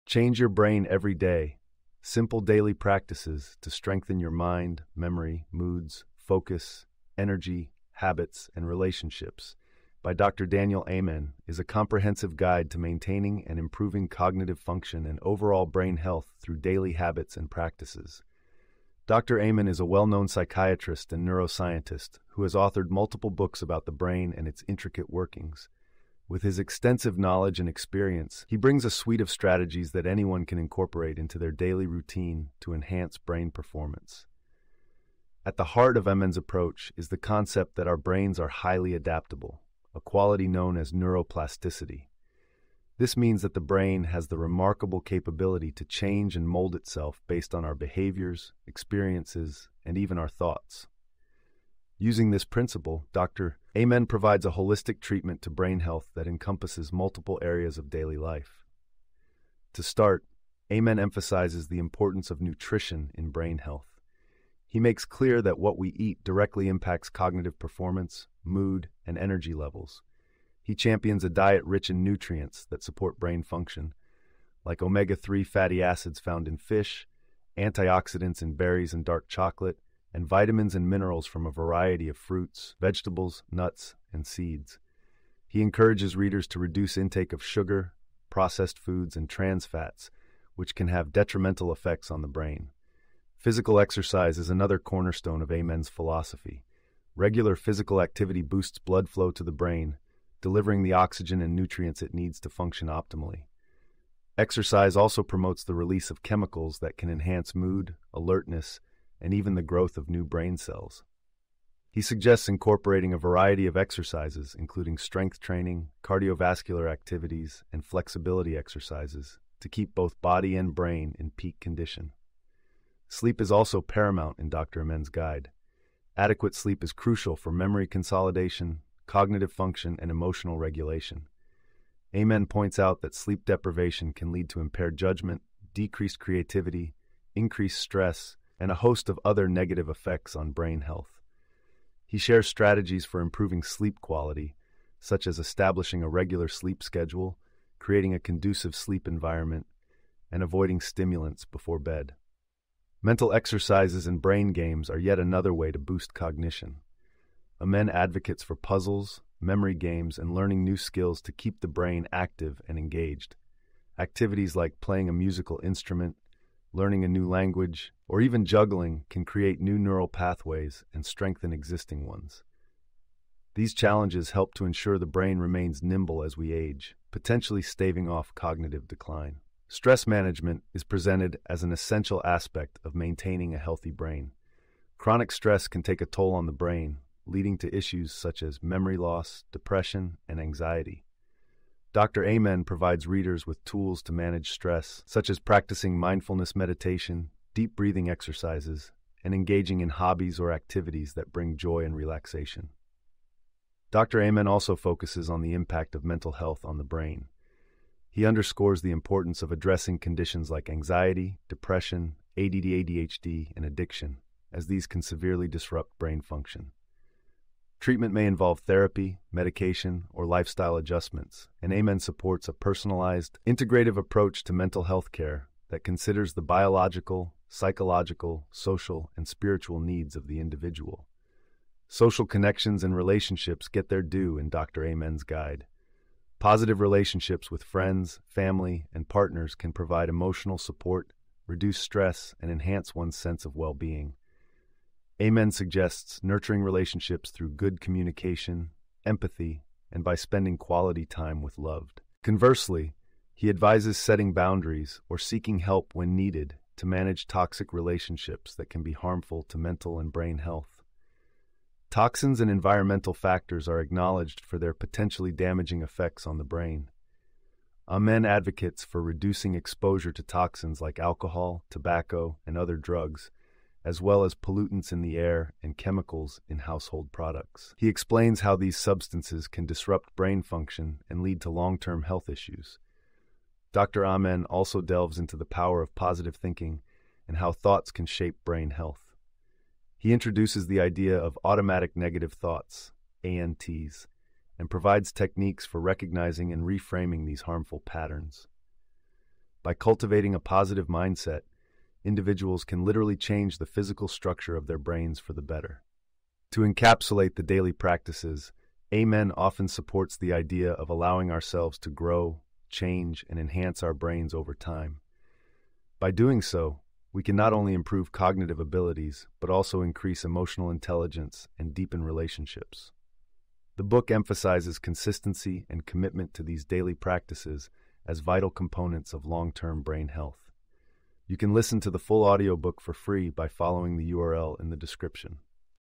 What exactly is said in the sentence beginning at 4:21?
Toxins and environmental factors are acknowledged for their potentially damaging effects on the brain.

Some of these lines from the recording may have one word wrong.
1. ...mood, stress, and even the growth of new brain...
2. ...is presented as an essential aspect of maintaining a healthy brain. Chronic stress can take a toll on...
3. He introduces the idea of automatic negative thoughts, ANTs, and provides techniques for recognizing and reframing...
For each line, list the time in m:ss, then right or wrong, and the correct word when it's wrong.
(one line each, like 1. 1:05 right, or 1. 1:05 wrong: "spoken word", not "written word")
1. 1:47 wrong: "alertness", not "stress"
2. 3:00 right
3. 4:49 right.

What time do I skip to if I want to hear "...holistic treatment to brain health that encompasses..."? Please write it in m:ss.
0:54.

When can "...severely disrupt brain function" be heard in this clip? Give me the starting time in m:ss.
3:35.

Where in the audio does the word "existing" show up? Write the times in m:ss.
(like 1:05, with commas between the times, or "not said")
2:51.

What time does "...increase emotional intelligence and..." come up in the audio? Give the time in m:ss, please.
5:19.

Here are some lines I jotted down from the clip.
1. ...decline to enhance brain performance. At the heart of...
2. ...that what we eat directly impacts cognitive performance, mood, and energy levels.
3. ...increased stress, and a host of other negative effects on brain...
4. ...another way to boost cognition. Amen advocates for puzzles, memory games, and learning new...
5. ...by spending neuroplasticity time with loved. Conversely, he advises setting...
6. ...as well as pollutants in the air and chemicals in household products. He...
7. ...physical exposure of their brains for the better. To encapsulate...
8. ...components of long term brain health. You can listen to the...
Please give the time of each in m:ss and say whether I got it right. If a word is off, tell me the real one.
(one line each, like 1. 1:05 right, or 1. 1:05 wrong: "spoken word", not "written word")
1. 0:31 wrong: "routine", not "decline"
2. 1:05 right
3. 2:17 right
4. 2:35 right
5. 4:10 wrong: "quality", not "neuroplasticity"
6. 4:33 right
7. 5:03 wrong: "structure", not "exposure"
8. 5:28 right.